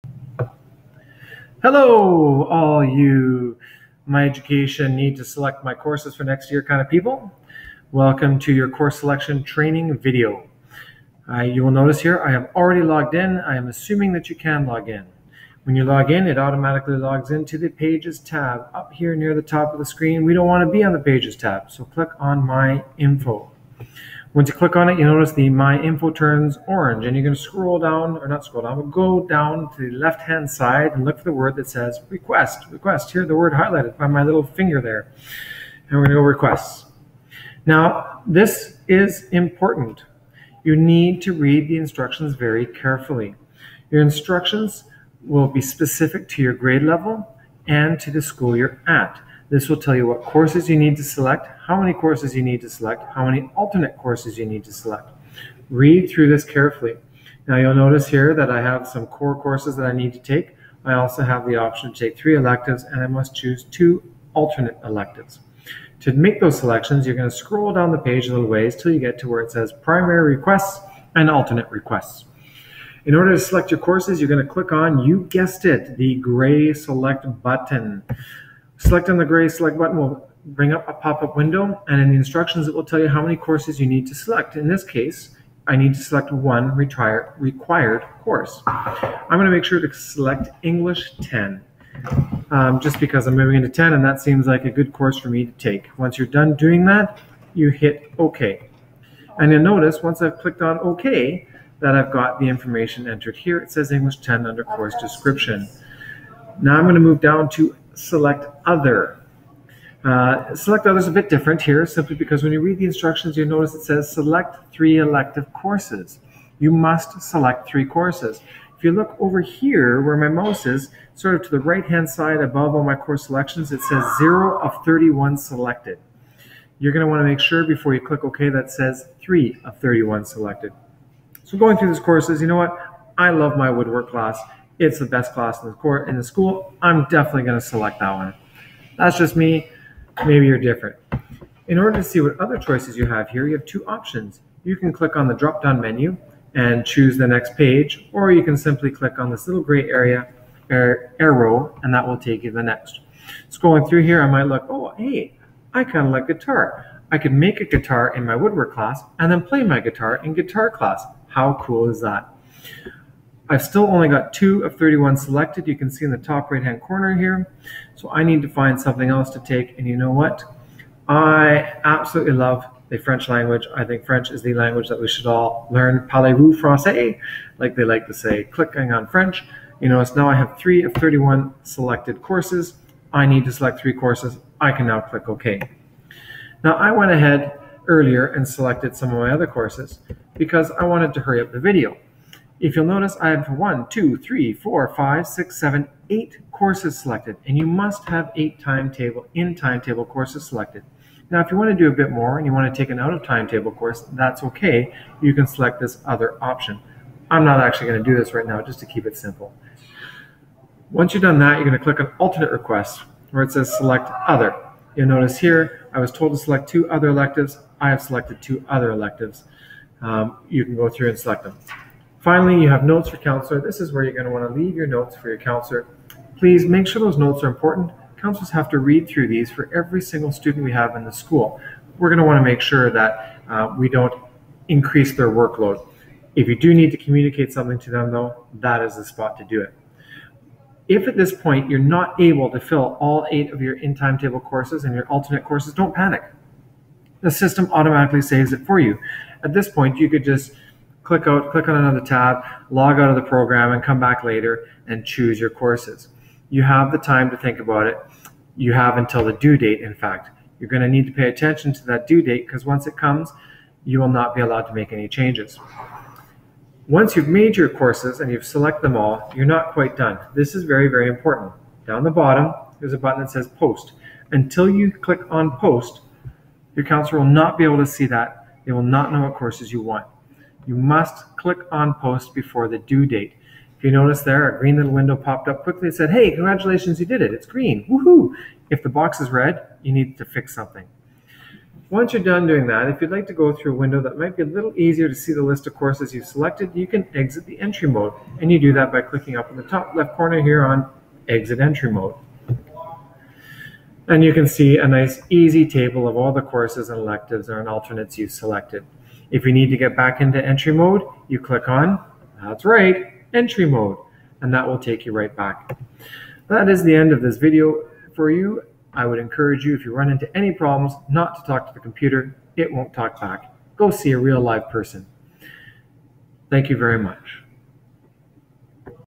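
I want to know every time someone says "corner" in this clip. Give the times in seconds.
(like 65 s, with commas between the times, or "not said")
166 s, 300 s.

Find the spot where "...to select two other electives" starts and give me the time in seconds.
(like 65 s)
216 s.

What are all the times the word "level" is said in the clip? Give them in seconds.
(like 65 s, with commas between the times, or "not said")
46 s.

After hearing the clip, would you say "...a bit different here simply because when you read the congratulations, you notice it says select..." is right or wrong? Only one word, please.
wrong.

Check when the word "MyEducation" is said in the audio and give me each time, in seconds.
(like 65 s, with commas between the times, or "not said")
4 s.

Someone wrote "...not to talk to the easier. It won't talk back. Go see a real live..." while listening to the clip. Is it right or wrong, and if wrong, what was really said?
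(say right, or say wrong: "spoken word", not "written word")
wrong: "computer", not "easier".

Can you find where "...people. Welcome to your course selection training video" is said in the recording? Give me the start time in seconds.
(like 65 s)
6 s.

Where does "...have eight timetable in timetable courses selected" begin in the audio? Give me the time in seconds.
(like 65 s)
198 s.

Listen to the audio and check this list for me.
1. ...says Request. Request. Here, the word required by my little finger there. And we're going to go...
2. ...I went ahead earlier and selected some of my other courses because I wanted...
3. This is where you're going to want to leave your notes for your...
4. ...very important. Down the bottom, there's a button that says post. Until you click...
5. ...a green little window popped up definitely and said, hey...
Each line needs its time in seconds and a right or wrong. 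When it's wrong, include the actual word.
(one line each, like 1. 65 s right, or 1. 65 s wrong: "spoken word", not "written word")
1. 31 s wrong: "highlighted", not "required"
2. 186 s right
3. 223 s right
4. 270 s right
5. 284 s wrong: "quickly", not "definitely".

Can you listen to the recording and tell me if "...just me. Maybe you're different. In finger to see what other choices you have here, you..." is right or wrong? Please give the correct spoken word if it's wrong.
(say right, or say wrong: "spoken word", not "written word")
wrong: "order", not "finger".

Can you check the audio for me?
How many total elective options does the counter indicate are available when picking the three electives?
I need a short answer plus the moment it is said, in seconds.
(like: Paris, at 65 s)
31, at 124 s.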